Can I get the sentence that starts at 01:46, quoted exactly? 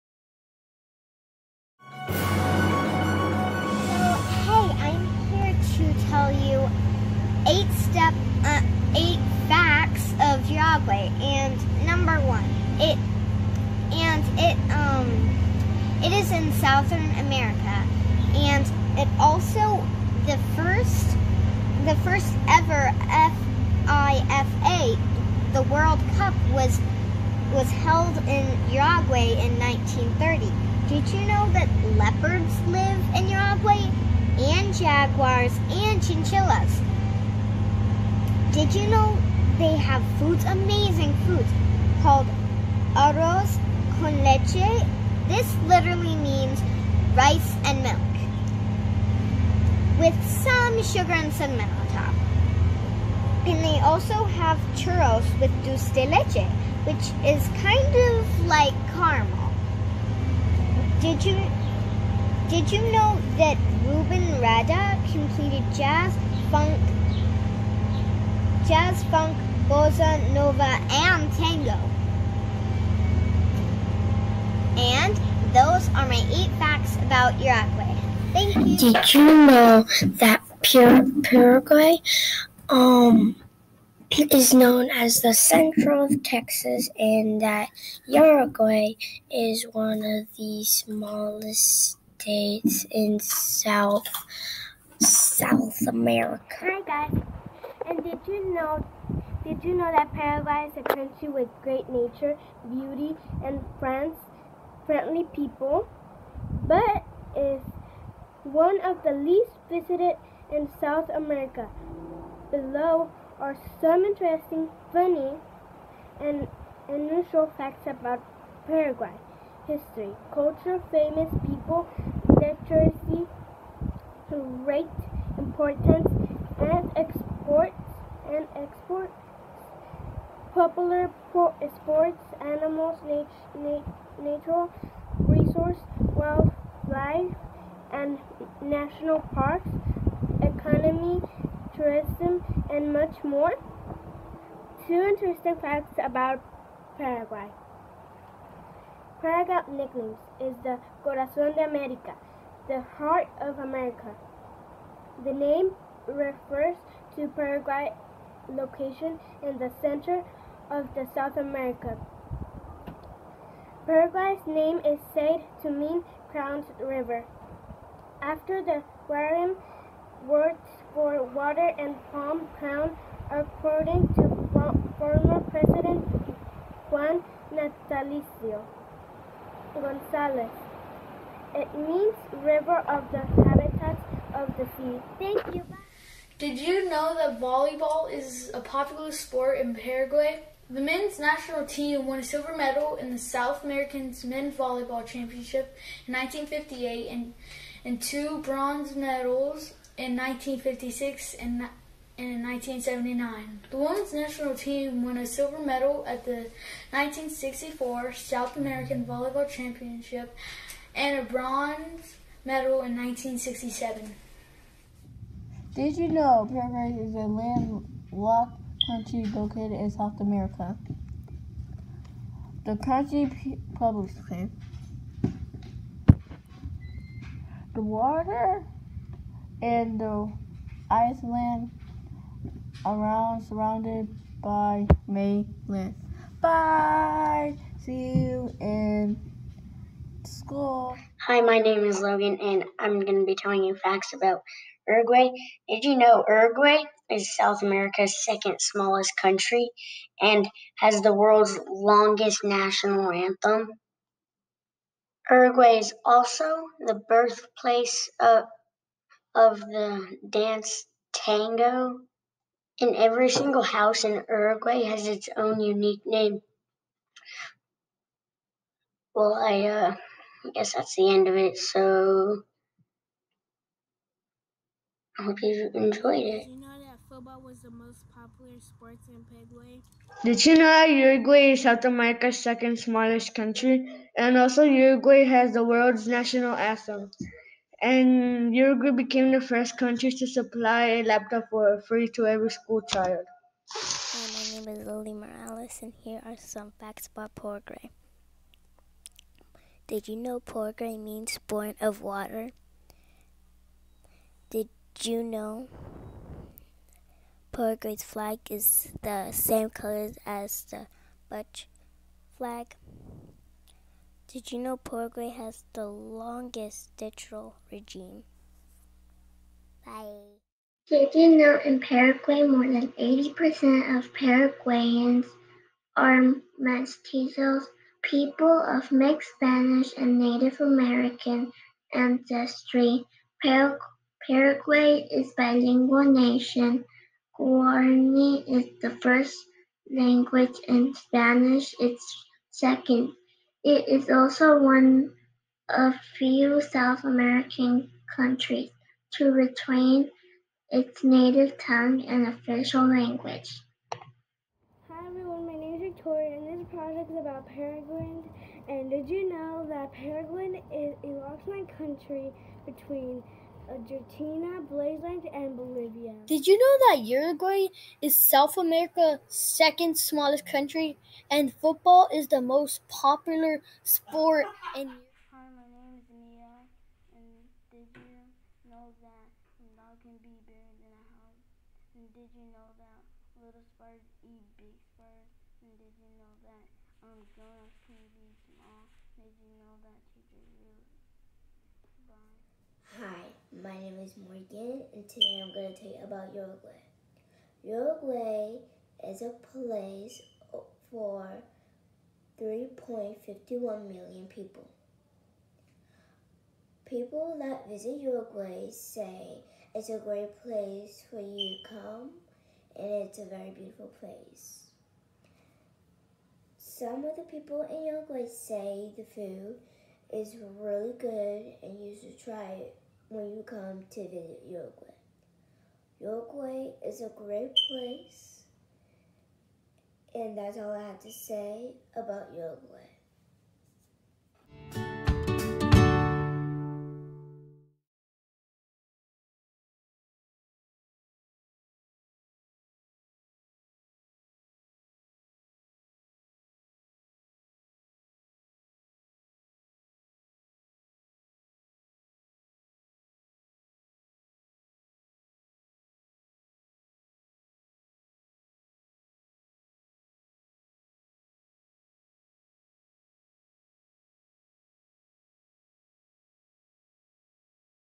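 But is one of the least visited in South America.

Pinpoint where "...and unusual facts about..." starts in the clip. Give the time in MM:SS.
01:56.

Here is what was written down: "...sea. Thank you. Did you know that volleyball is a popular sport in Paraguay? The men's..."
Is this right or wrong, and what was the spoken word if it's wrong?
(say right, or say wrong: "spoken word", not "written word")
right.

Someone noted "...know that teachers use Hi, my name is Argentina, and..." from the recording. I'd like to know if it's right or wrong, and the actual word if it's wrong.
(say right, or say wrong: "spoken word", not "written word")
wrong: "Morgan", not "Argentina".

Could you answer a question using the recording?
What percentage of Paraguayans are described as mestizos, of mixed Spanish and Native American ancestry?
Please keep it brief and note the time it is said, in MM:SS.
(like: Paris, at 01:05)
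More than 80%, at 05:22.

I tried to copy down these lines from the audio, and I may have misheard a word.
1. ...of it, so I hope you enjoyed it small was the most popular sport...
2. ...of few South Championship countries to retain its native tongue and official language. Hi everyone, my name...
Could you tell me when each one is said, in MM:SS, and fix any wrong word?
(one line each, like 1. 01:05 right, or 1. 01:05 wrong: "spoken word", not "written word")
1. 04:31 wrong: "football", not "small"
2. 05:45 wrong: "American", not "Championship".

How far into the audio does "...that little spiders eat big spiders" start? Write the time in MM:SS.
06:22.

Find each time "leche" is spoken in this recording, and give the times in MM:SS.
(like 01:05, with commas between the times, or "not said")
00:44, 00:56.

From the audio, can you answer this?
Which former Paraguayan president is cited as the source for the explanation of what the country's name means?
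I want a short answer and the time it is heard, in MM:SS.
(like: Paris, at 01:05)
Juan Natalicio Gonzalez, at 02:56.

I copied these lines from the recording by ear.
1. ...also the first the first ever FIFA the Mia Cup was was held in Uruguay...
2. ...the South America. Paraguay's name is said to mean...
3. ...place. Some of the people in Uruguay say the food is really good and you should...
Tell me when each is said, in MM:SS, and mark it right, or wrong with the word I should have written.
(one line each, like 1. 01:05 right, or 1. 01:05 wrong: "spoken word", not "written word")
1. 00:19 wrong: "World", not "Mia"
2. 02:40 right
3. 06:54 right.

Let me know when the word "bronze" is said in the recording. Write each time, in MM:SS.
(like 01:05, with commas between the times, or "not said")
03:18, 03:31.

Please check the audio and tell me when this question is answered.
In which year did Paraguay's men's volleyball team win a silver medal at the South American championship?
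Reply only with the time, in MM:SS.
03:16.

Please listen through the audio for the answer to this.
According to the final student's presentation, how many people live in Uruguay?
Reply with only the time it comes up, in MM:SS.
06:42.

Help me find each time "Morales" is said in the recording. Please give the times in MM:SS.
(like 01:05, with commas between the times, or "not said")
04:55.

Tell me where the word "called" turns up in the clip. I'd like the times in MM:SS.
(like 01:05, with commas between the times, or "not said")
00:42.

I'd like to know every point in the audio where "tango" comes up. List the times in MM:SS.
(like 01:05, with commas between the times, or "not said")
01:11, 04:21.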